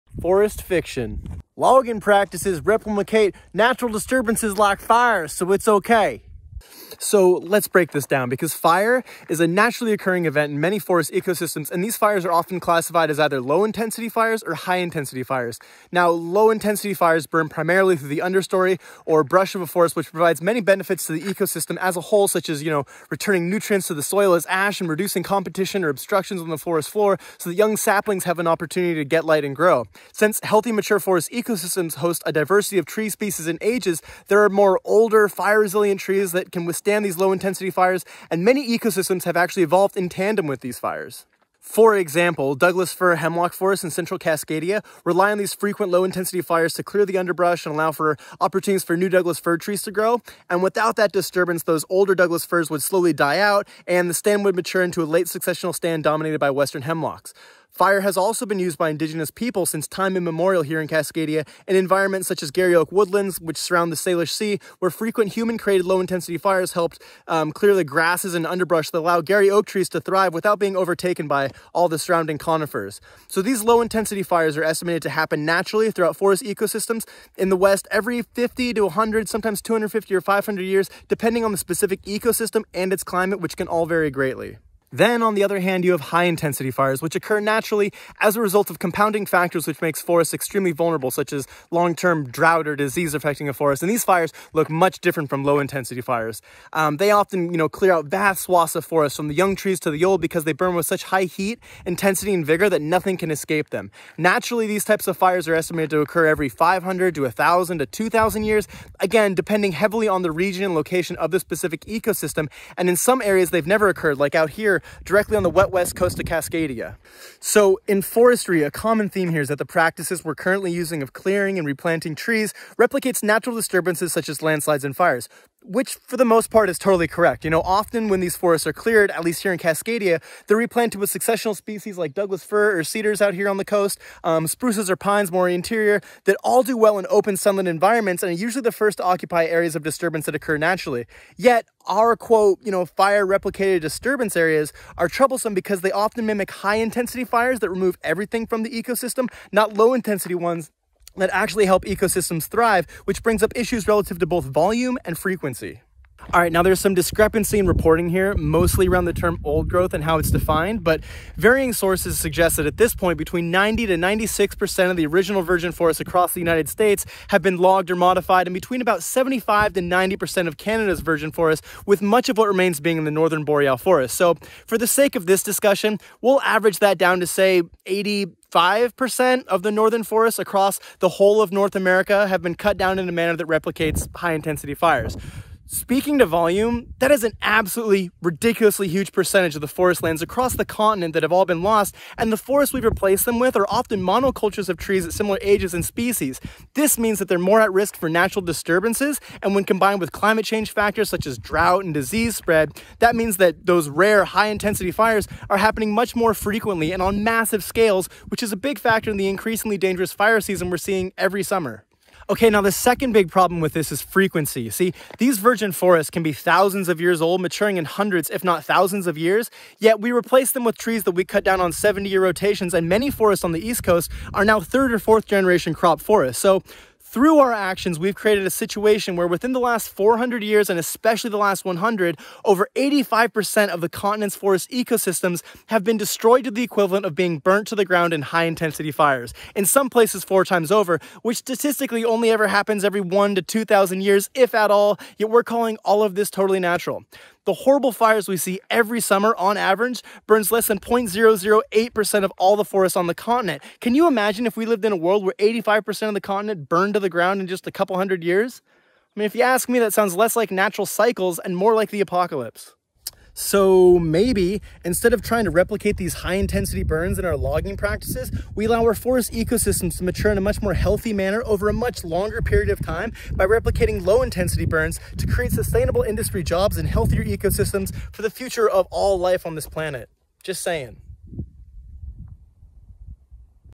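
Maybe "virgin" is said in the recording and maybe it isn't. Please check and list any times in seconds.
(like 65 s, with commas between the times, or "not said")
165 s, 171 s, 215 s.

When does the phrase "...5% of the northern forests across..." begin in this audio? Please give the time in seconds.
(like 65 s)
178 s.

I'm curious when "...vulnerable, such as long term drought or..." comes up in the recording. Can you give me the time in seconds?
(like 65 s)
90 s.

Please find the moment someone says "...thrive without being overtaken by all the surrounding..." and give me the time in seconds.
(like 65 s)
70 s.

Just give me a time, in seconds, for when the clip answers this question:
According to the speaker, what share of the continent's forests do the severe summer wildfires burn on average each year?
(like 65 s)
250 s.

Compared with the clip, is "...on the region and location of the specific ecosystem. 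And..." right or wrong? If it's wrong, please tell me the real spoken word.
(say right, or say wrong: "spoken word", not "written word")
right.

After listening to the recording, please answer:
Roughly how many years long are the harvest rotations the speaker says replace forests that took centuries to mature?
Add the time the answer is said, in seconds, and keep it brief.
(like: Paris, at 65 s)
70, at 221 s.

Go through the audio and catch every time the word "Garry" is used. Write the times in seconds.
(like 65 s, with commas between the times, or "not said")
62 s, 69 s.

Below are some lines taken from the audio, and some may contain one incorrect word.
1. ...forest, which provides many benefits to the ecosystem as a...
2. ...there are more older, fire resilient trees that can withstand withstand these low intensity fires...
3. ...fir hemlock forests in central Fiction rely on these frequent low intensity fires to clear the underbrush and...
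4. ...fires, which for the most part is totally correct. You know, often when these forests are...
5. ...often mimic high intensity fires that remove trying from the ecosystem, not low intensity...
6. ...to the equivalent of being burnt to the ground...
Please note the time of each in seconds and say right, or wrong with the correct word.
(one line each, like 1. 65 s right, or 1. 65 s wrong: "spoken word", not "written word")
1. 19 s right
2. 34 s right
3. 42 s wrong: "Cascadia", not "Fiction"
4. 124 s right
5. 145 s wrong: "everything", not "trying"
6. 236 s right.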